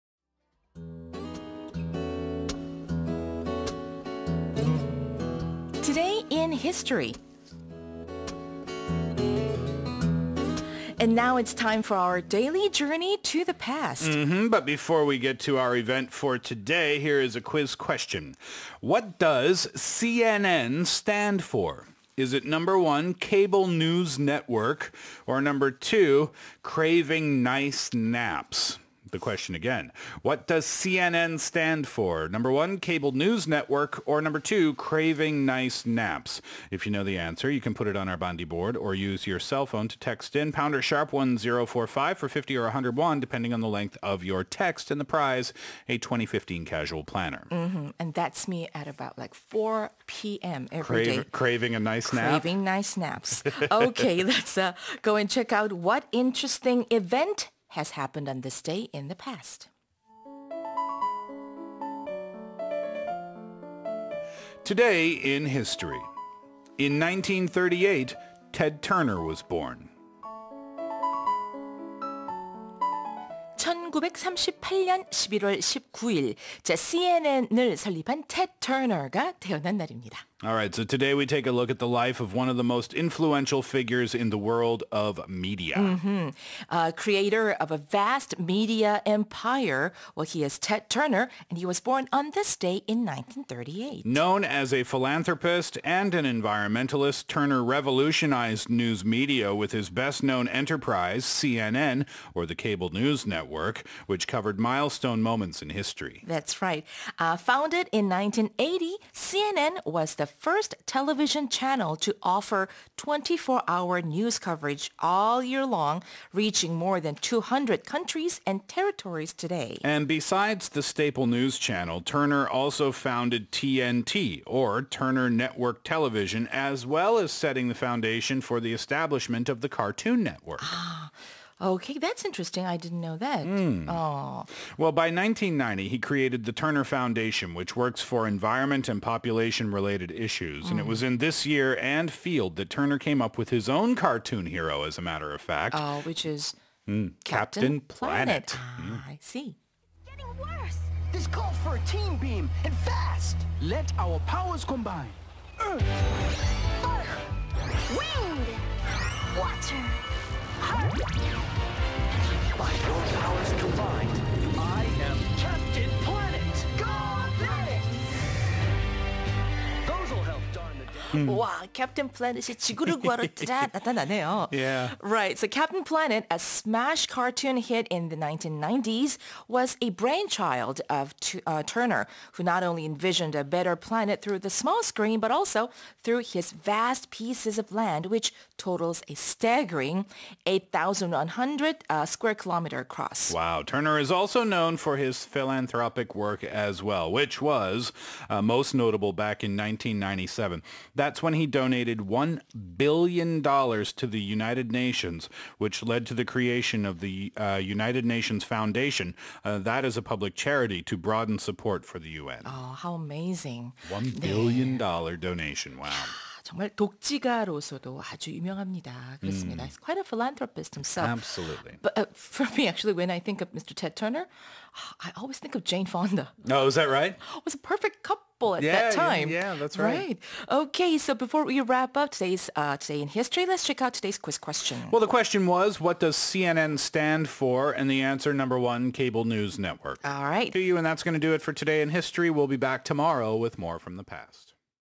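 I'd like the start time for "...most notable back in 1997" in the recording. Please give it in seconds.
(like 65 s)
198 s.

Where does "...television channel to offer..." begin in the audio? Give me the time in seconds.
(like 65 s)
110 s.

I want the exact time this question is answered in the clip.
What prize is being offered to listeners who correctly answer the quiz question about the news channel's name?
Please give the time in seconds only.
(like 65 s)
45 s.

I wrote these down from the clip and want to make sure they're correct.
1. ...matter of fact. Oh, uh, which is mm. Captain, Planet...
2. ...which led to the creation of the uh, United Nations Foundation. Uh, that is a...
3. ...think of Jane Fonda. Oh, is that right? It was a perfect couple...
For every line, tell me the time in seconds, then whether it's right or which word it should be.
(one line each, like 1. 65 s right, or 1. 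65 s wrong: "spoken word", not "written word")
1. 145 s wrong: "Captain", not "Planet"
2. 205 s right
3. 225 s right.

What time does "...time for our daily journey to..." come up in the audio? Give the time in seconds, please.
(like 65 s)
11 s.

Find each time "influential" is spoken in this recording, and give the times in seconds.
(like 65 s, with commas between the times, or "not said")
82 s.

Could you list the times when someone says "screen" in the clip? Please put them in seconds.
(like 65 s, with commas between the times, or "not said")
184 s.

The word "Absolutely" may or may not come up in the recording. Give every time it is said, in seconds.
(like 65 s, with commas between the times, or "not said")
221 s.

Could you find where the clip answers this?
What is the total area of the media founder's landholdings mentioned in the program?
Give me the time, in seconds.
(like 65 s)
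190 s.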